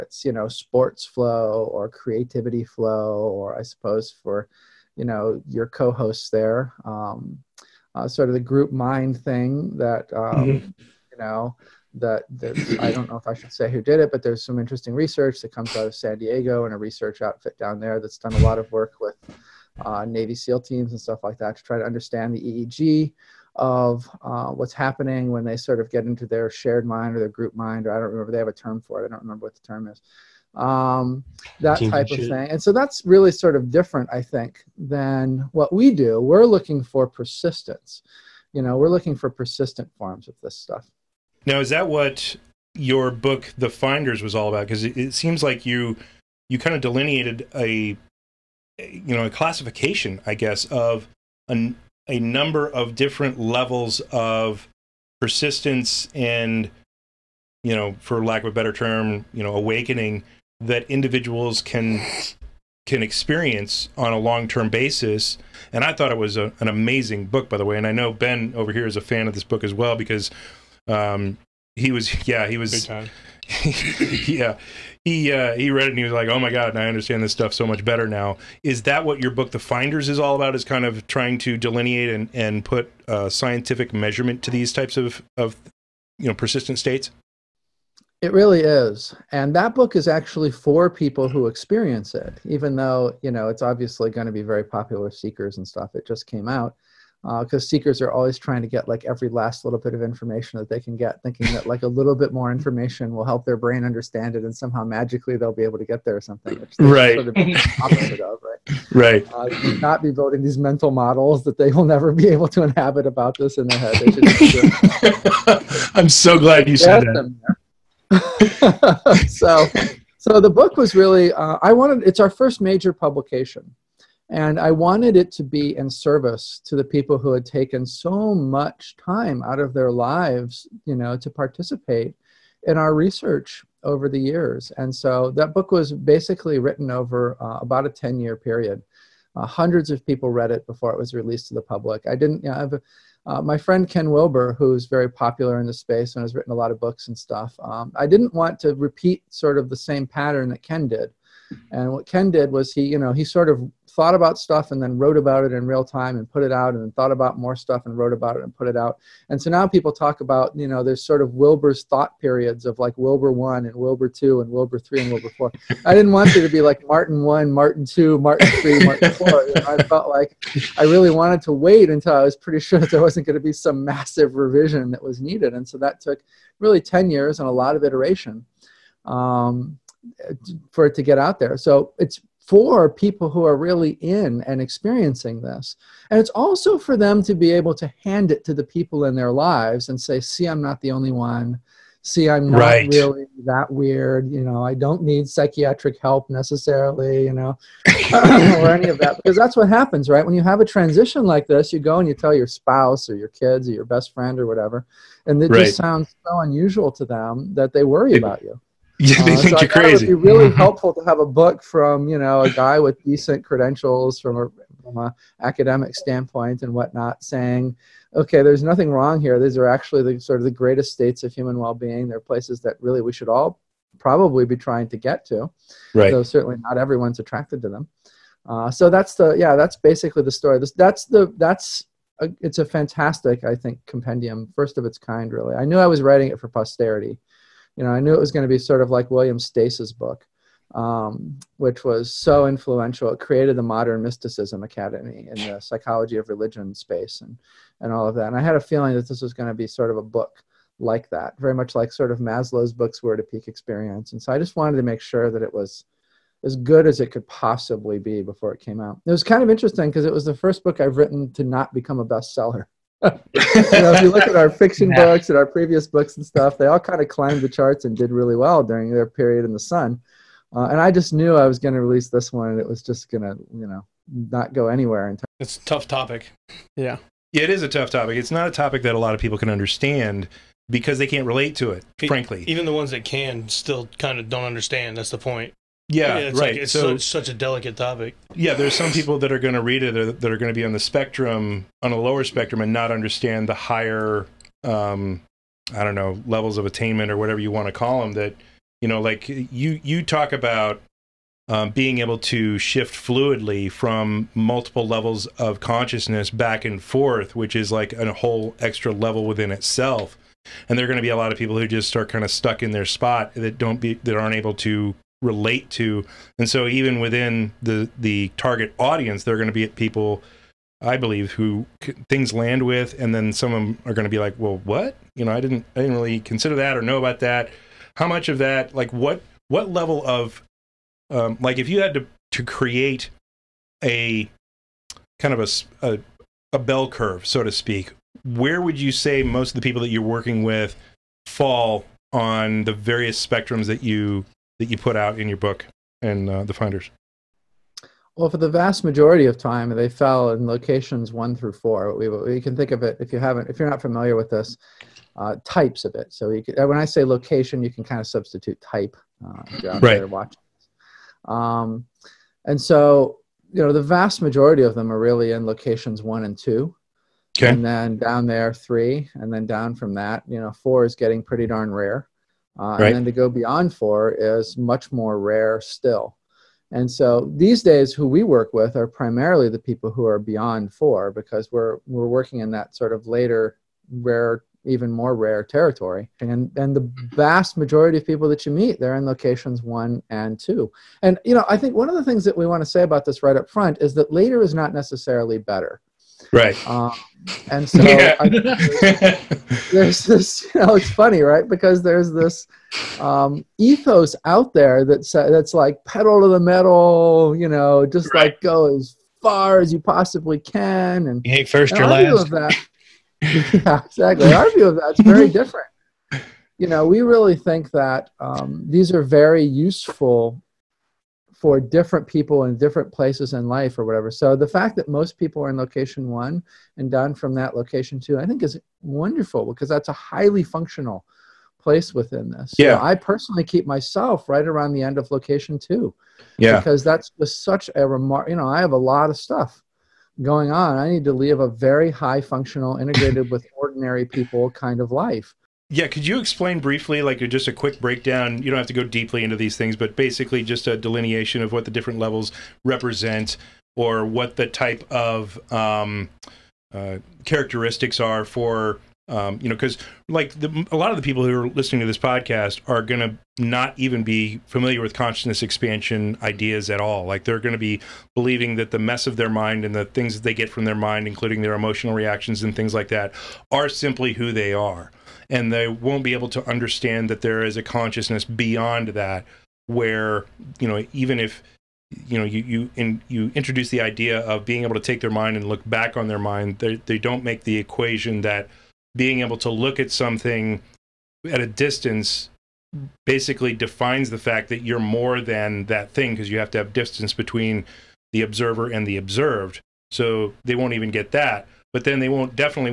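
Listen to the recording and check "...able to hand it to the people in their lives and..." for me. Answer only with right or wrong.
right.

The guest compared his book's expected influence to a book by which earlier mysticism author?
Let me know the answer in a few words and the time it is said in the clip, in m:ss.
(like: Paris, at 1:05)
William Stace, at 3:59.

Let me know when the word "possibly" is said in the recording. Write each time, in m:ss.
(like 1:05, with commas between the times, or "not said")
4:17, 6:49.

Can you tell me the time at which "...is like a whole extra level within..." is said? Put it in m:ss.
5:07.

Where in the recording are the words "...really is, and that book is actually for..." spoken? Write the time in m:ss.
1:28.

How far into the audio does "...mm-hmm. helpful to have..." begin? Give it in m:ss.
3:30.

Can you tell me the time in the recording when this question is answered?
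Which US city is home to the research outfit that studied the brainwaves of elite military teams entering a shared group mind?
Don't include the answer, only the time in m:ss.
0:15.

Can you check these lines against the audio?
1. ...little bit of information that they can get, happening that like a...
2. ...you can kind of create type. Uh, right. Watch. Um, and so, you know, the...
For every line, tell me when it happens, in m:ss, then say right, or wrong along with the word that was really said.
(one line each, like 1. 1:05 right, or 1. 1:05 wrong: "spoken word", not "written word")
1. 1:39 wrong: "thinking", not "happening"
2. 5:57 wrong: "substitute", not "create".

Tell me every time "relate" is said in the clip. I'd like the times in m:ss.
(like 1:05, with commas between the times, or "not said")
4:41, 5:15.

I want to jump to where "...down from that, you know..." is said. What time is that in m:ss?
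6:09.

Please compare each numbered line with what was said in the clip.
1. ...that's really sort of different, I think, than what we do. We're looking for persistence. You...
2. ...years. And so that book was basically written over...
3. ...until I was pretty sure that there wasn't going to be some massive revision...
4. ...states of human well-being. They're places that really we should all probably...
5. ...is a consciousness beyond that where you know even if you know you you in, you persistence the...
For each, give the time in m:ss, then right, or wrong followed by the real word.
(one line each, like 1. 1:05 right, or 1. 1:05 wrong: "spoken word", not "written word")
1. 0:32 right
2. 2:14 right
3. 2:51 right
4. 3:40 right
5. 7:57 wrong: "introduce", not "persistence".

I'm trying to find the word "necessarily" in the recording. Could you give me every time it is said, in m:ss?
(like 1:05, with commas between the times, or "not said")
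3:16, 6:34.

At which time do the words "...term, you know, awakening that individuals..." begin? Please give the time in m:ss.
0:58.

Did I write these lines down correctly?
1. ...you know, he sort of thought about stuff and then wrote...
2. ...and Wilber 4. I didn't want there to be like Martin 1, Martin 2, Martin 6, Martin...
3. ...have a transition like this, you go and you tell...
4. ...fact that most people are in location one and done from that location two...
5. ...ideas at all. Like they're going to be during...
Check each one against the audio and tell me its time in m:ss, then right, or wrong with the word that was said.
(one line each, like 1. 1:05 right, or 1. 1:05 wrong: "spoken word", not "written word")
1. 2:32 right
2. 2:45 wrong: "3", not "6"
3. 3:20 right
4. 7:04 right
5. 7:46 wrong: "believing", not "during".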